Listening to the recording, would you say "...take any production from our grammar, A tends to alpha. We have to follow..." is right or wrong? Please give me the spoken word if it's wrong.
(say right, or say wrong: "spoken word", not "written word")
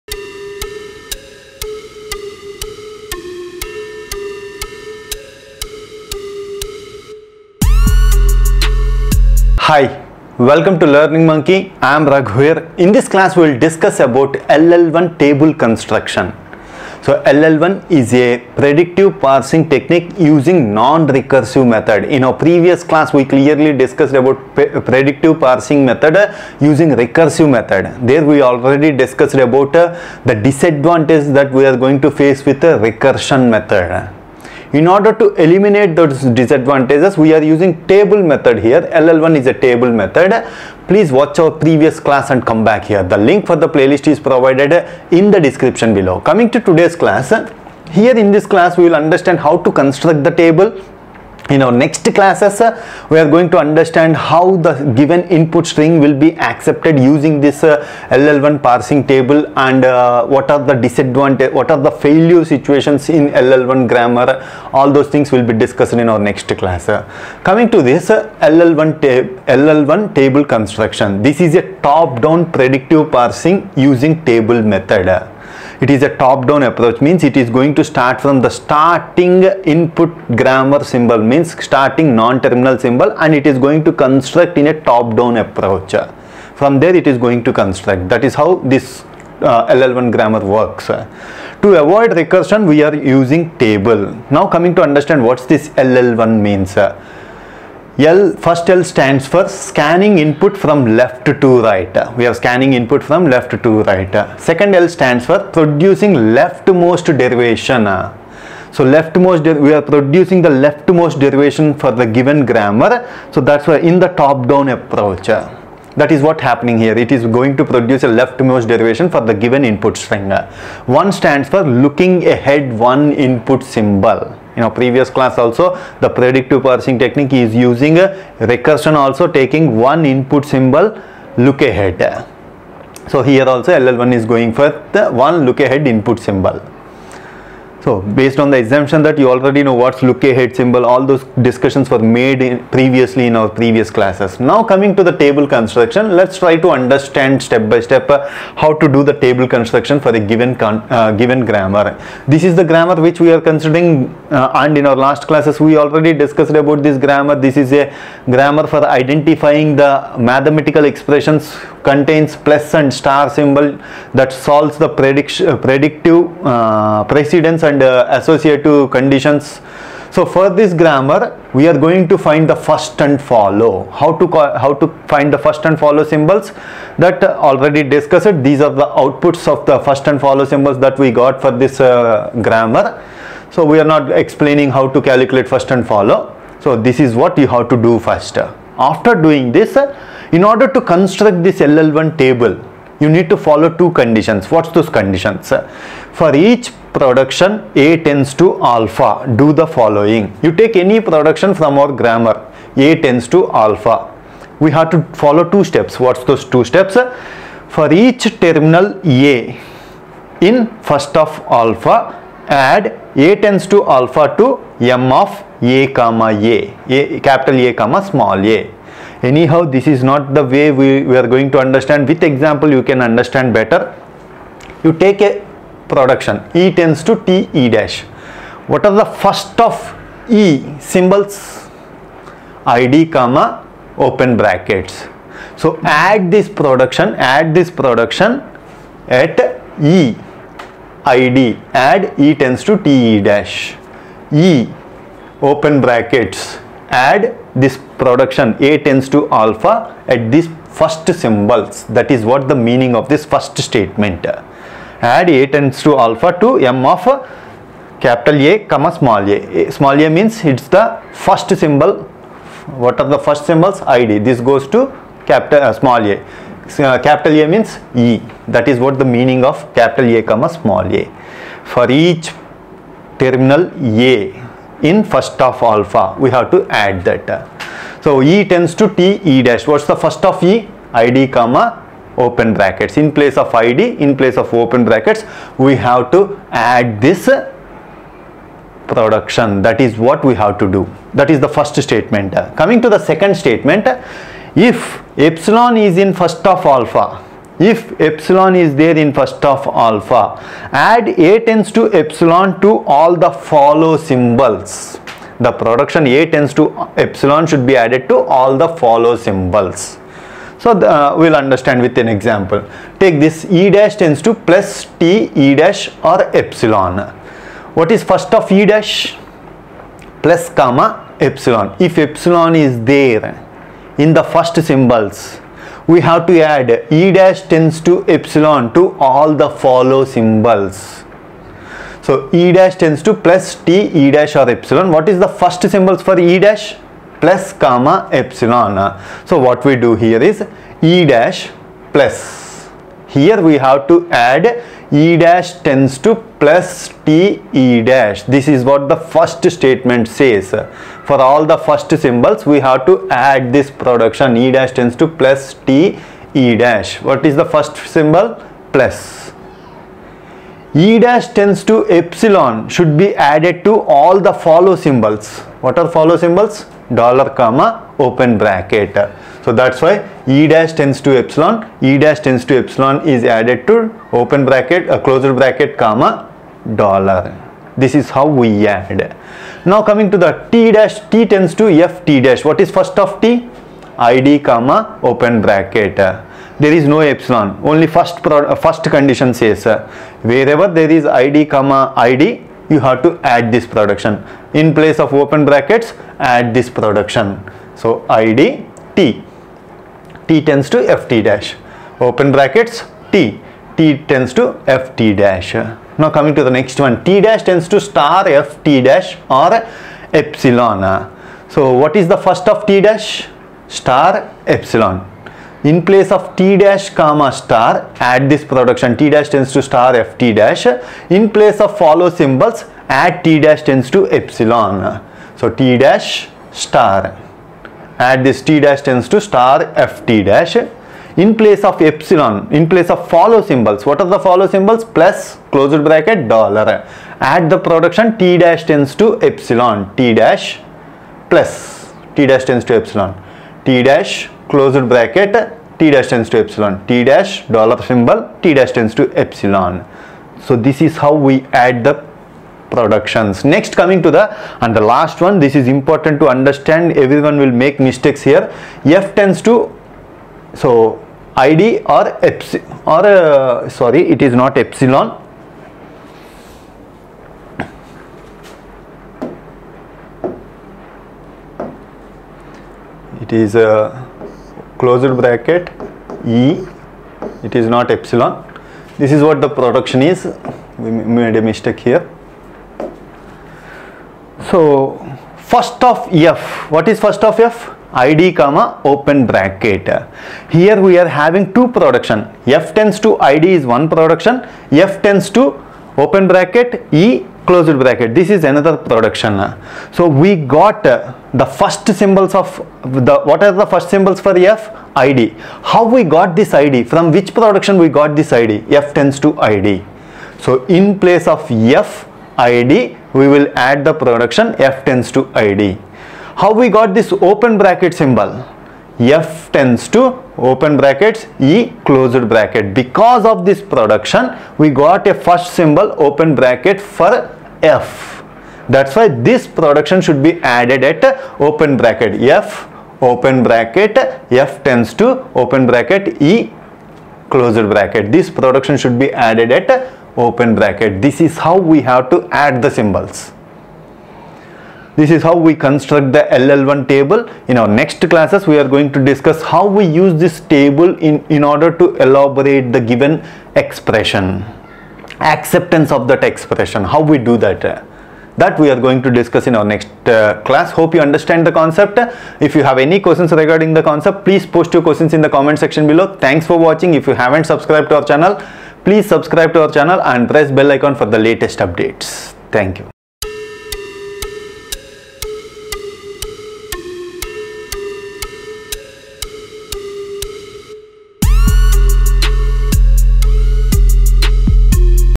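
right.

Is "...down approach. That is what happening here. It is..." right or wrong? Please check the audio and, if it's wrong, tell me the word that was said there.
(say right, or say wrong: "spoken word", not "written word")
right.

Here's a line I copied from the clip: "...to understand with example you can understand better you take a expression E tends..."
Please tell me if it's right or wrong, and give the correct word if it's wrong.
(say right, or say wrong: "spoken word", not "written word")
wrong: "production", not "expression".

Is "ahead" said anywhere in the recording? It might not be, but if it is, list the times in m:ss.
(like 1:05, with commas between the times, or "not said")
2:02, 2:11, 2:15, 2:20.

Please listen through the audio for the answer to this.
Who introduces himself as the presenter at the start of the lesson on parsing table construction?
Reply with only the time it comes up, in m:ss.
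0:12.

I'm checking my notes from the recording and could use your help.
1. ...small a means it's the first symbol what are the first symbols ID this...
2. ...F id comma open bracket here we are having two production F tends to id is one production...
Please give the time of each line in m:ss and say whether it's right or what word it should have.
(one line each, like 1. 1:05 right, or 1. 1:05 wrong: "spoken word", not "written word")
1. 4:19 right
2. 8:07 right.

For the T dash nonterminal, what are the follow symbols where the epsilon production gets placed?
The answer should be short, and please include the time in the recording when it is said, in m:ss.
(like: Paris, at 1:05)
Plus, closed bracket, dollar, at 7:14.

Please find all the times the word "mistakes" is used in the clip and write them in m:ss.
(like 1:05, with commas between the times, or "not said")
7:37, 8:01.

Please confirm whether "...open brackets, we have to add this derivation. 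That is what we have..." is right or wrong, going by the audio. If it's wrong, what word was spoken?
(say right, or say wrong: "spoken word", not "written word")
wrong: "production", not "derivation".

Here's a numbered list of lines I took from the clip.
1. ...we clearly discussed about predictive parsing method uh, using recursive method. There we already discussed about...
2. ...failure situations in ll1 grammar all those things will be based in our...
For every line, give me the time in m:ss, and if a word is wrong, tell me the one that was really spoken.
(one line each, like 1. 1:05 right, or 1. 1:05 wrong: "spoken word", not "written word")
1. 0:23 right
2. 1:02 wrong: "discussed", not "based".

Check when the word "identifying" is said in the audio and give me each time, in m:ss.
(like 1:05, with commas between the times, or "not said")
2:38.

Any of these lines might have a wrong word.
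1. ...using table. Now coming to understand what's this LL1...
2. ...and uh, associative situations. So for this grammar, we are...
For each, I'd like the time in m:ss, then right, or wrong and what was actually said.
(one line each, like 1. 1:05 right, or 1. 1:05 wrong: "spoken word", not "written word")
1. 1:32 right
2. 2:47 wrong: "conditions", not "situations".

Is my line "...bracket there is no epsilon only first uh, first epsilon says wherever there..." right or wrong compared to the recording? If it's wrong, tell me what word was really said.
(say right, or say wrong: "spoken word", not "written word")
wrong: "condition", not "epsilon".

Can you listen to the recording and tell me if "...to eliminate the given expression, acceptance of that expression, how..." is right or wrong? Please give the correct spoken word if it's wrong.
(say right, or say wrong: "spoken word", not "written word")
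wrong: "elaborate", not "eliminate".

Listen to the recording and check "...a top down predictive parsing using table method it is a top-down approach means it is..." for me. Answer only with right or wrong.
right.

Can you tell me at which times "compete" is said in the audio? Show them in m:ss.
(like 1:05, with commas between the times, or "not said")
not said.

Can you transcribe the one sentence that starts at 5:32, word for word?
So e dash tends to plus t e dash or epsilon.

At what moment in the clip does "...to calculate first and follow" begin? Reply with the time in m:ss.
3:04.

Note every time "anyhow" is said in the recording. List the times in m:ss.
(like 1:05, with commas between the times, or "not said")
3:39.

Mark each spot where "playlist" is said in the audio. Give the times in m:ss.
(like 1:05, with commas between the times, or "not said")
0:43.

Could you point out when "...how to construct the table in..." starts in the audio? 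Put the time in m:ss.
0:49.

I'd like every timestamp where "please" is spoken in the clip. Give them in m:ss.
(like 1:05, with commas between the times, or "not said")
0:40, 9:24, 9:28.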